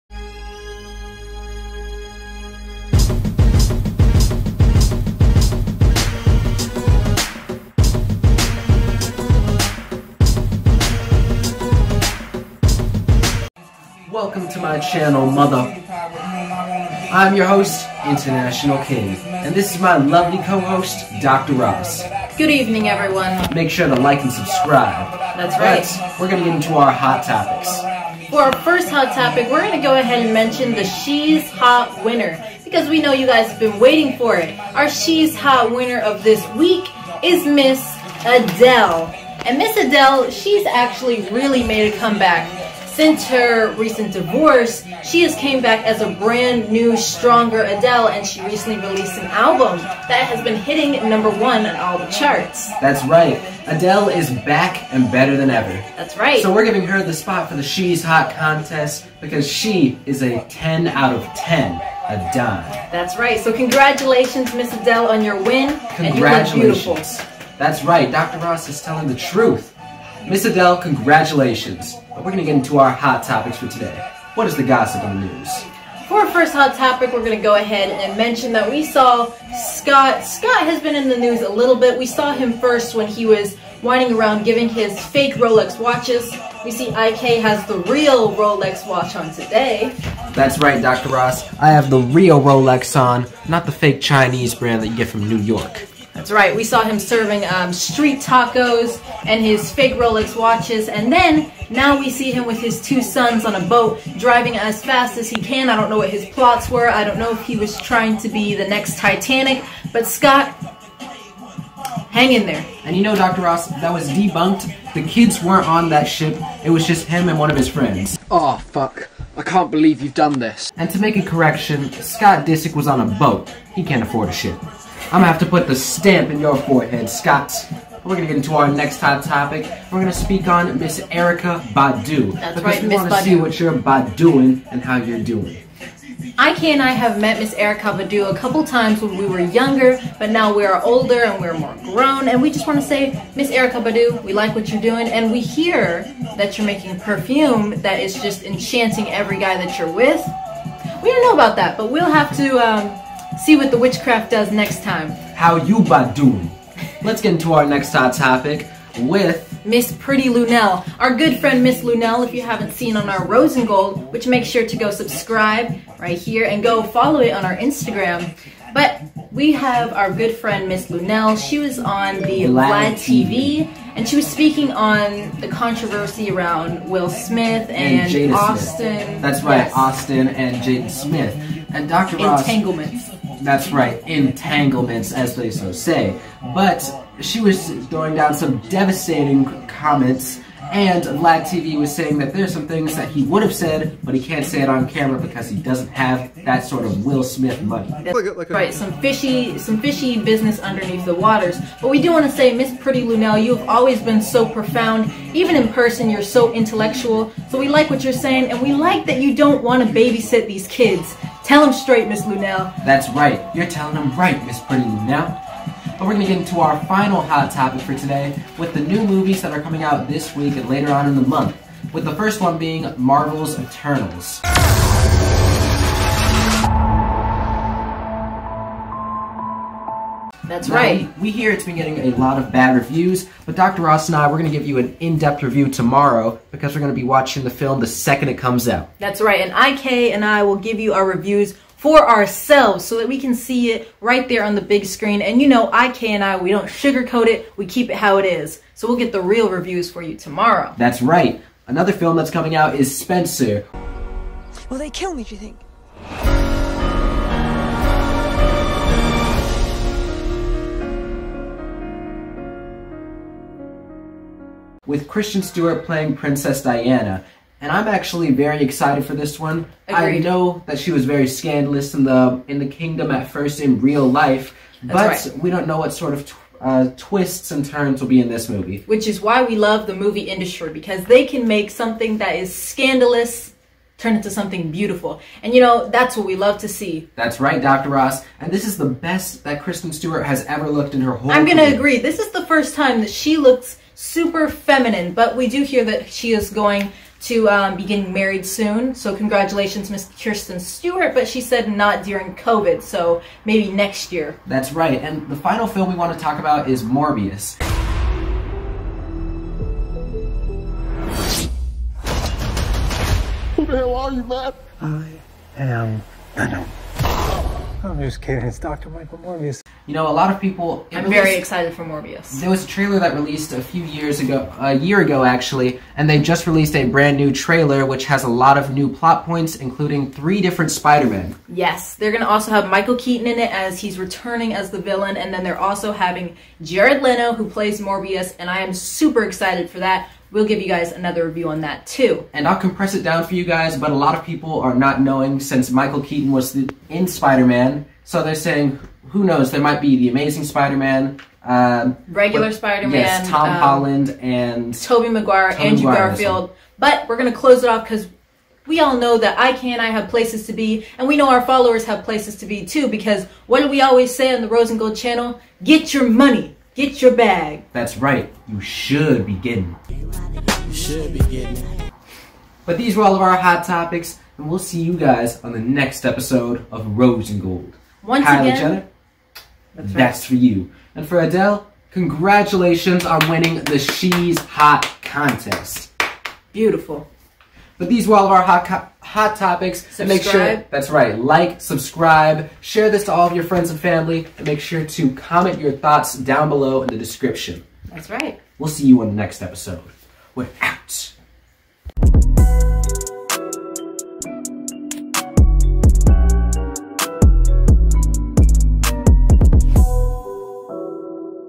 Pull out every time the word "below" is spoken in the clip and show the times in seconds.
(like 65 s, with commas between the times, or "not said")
396 s.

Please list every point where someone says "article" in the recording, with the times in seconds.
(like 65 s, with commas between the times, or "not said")
not said.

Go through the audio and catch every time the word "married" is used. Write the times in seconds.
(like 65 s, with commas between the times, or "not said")
298 s.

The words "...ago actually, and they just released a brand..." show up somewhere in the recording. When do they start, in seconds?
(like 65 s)
325 s.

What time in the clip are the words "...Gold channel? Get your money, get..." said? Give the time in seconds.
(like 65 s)
364 s.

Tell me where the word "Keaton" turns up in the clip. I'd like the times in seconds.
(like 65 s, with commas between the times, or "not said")
332 s, 346 s.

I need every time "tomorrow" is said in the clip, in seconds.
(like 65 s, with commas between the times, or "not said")
235 s, 250 s.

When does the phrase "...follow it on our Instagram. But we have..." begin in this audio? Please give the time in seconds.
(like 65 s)
166 s.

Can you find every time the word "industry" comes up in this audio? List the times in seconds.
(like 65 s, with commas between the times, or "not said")
280 s.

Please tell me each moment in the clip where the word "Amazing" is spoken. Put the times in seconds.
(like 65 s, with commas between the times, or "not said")
350 s.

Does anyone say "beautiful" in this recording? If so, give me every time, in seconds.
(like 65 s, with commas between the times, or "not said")
284 s, 386 s.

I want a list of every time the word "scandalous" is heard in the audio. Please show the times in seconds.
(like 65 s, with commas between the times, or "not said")
271 s, 282 s.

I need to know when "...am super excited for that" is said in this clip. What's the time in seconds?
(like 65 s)
338 s.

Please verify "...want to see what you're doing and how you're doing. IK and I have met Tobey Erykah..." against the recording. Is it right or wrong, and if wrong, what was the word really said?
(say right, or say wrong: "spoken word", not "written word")
wrong: "Miss", not "Tobey".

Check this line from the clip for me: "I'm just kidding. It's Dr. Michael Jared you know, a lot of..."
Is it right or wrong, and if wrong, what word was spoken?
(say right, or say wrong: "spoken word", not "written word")
wrong: "Morbius", not "Jared".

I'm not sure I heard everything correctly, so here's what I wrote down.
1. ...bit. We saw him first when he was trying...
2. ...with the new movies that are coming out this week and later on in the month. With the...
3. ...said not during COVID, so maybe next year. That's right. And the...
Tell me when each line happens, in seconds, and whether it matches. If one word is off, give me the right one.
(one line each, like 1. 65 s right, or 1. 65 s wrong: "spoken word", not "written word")
1. 81 s wrong: "winding", not "trying"
2. 218 s right
3. 301 s right.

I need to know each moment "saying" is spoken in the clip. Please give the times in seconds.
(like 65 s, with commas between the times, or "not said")
191 s, 208 s, 348 s.